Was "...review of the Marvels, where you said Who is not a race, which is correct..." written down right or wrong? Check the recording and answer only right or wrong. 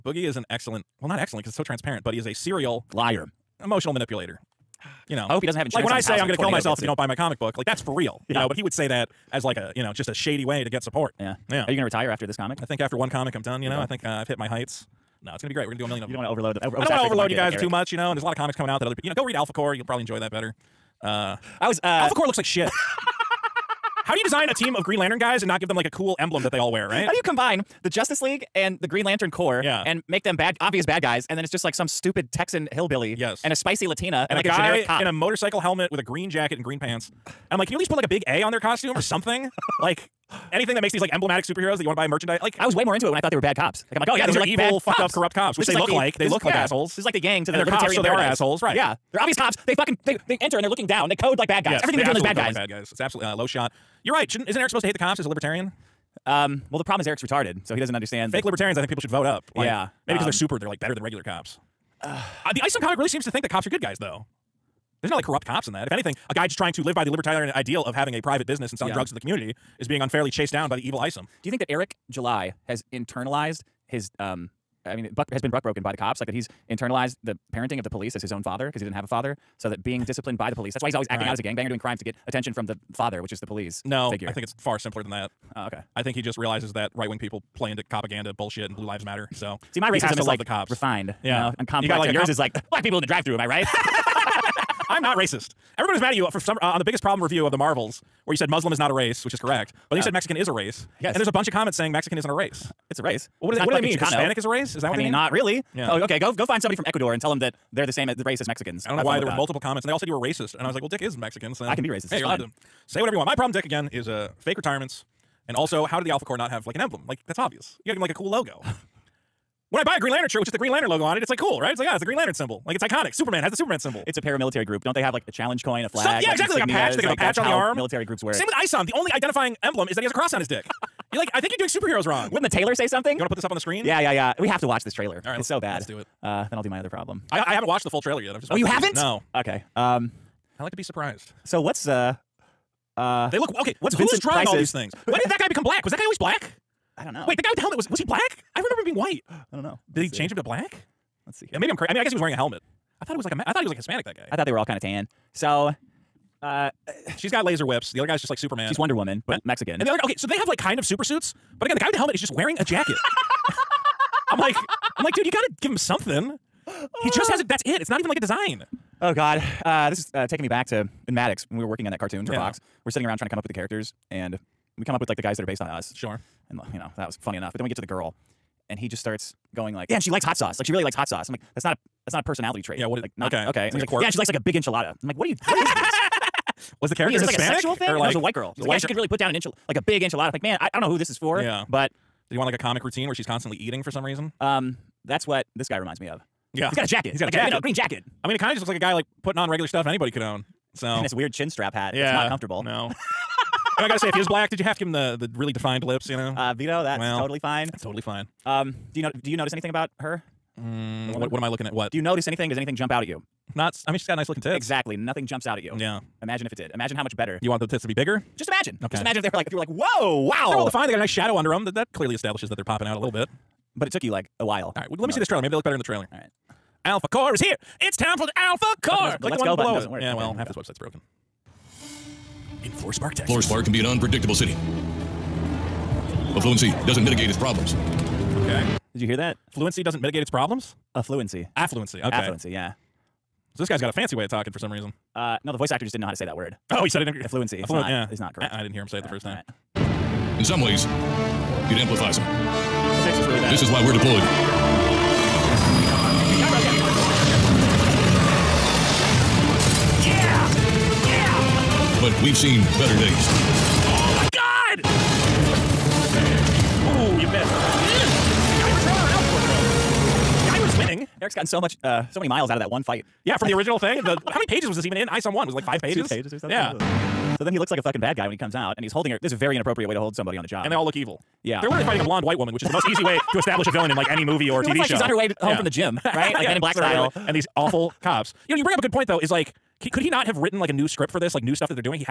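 wrong.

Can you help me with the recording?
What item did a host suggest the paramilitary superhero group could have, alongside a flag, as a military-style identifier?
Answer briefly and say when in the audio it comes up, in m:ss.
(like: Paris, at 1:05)
a challenge coin, at 2:05.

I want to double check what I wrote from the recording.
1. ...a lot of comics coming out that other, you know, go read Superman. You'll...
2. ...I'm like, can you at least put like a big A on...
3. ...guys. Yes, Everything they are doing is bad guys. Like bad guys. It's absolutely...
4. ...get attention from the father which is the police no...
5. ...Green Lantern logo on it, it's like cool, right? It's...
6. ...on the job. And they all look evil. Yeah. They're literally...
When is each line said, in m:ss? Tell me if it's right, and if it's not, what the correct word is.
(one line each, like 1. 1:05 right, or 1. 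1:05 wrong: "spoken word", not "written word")
1. 0:18 wrong: "Alphacore", not "Superman"
2. 0:37 right
3. 0:51 right
4. 1:22 right
5. 2:00 right
6. 4:40 right.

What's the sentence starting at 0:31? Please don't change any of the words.
And then it's just like some stupid Texan hillbilly.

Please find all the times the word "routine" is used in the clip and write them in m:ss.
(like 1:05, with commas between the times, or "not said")
3:12.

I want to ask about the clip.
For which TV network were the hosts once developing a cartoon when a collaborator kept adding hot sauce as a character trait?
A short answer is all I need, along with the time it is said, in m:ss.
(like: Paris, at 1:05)
Fox, at 2:52.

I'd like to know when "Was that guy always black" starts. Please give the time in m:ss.
2:25.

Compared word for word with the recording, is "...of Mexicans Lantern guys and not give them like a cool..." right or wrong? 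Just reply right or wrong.
wrong.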